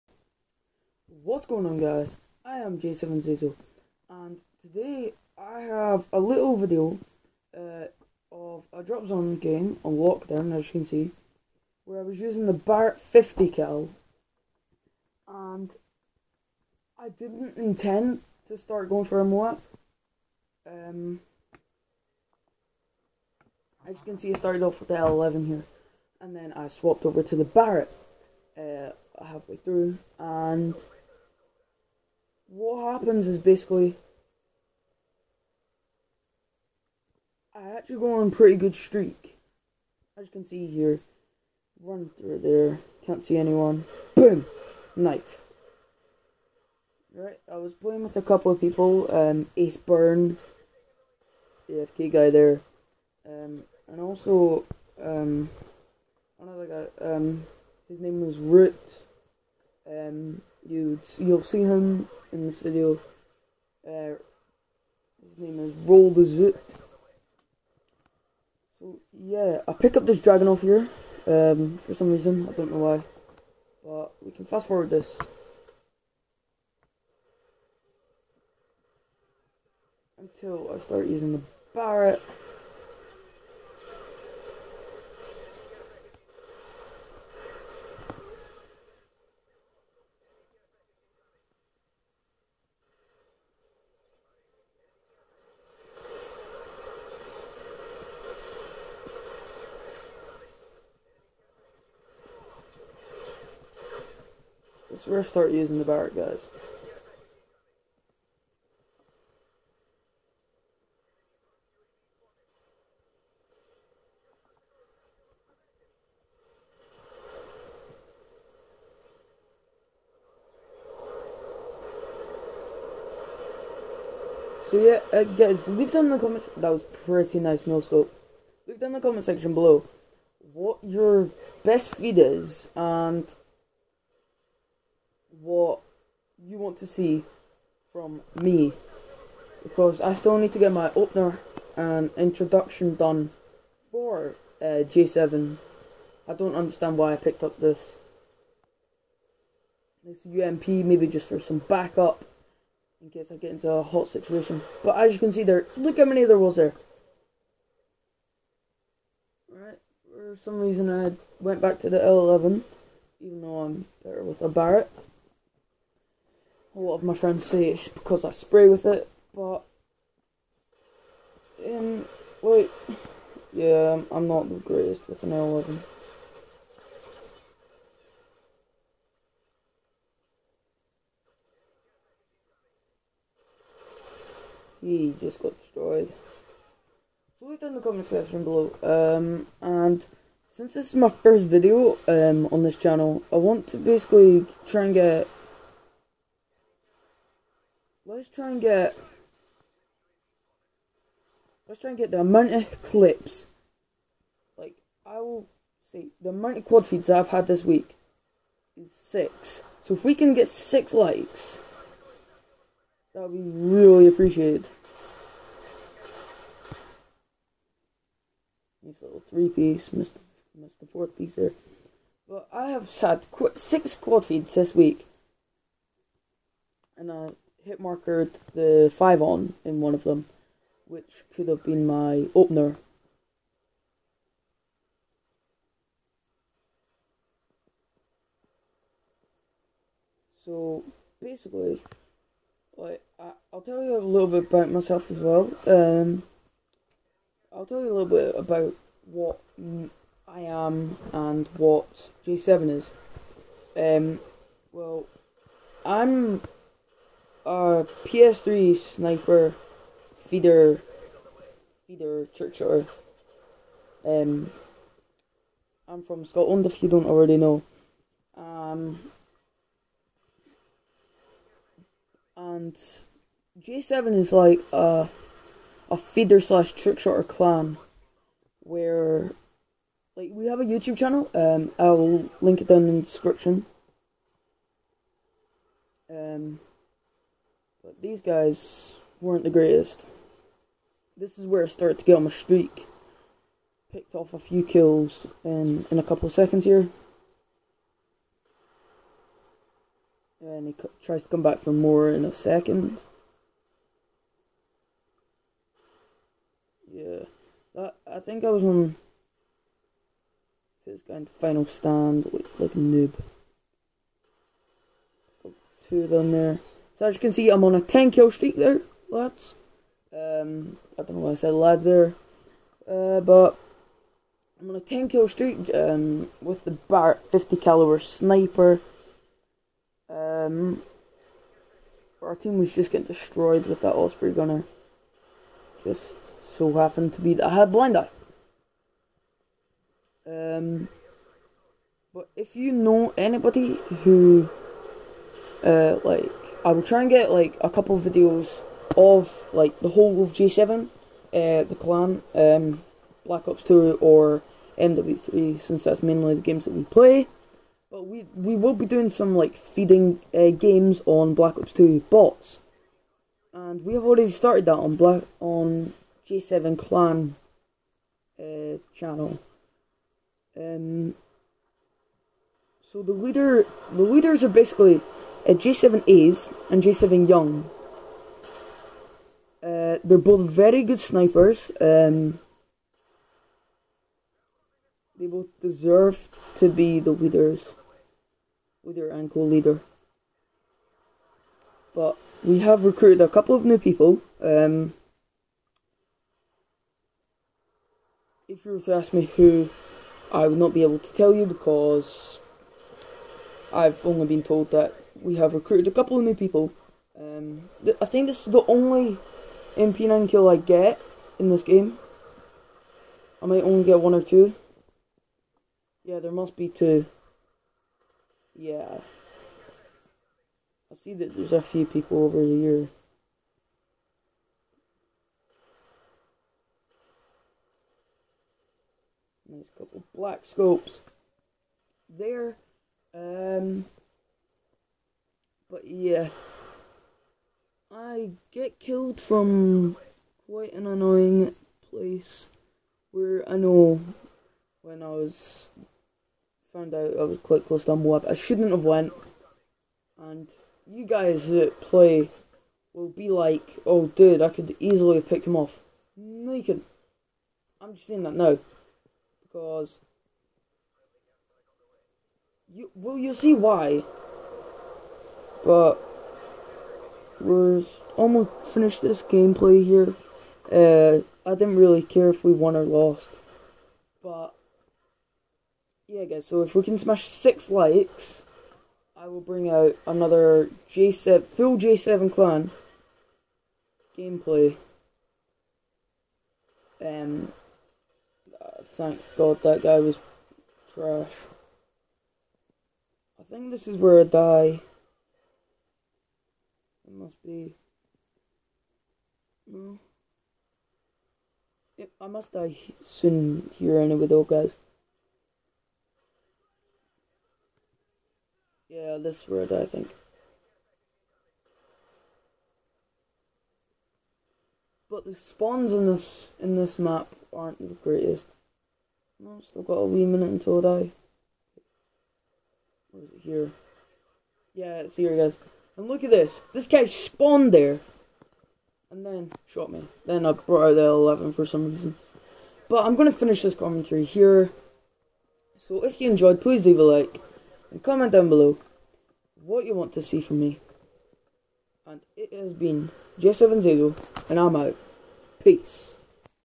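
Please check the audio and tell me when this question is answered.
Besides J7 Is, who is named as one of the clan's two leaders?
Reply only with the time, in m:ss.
6:16.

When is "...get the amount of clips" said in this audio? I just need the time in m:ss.
3:21.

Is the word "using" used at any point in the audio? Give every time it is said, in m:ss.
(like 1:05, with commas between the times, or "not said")
0:12, 1:21, 1:45.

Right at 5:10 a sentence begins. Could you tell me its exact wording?
This guy into final stand, like, like a noob.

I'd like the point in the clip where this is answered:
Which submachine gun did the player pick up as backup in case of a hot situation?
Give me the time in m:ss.
2:30.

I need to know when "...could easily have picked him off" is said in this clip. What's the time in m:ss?
7:34.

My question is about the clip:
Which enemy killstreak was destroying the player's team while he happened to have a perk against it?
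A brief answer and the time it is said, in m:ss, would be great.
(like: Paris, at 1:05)
Osprey gunner, at 5:33.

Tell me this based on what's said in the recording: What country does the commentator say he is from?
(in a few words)
Scotland.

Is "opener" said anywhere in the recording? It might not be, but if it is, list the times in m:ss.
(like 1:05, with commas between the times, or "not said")
2:20, 3:52.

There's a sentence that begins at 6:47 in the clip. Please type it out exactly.
Um, th- I think this is the only MP9 kill I get in this game.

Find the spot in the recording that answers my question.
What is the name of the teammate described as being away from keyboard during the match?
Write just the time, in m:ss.
0:49.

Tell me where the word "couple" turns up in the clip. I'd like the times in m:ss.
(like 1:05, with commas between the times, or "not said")
0:48, 4:56, 5:47, 6:33, 6:45, 7:09.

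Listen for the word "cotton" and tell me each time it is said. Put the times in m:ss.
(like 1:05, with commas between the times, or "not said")
not said.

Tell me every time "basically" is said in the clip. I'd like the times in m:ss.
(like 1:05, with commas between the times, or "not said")
0:33, 3:13, 4:01, 6:14.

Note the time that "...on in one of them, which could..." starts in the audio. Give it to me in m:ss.
3:49.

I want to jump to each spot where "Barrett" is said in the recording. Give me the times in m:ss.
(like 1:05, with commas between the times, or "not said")
0:12, 0:27, 1:21, 1:45, 2:44.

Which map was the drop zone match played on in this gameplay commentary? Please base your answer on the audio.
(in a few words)
Lockdown.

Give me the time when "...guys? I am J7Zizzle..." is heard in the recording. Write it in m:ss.
0:01.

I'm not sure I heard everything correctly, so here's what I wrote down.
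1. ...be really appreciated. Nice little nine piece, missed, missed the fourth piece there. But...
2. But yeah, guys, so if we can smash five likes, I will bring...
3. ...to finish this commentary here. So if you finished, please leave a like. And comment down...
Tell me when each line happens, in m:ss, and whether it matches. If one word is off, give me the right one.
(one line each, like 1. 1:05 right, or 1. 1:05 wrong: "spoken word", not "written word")
1. 3:33 wrong: "three", not "nine"
2. 7:54 wrong: "six", not "five"
3. 8:53 wrong: "enjoyed", not "finished".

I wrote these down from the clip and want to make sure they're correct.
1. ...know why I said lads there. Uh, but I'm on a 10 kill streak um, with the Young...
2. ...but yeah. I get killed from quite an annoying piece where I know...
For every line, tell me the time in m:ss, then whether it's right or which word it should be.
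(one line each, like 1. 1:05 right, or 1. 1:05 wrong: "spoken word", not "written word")
1. 5:21 wrong: "Bart", not "Young"
2. 7:15 wrong: "place", not "piece".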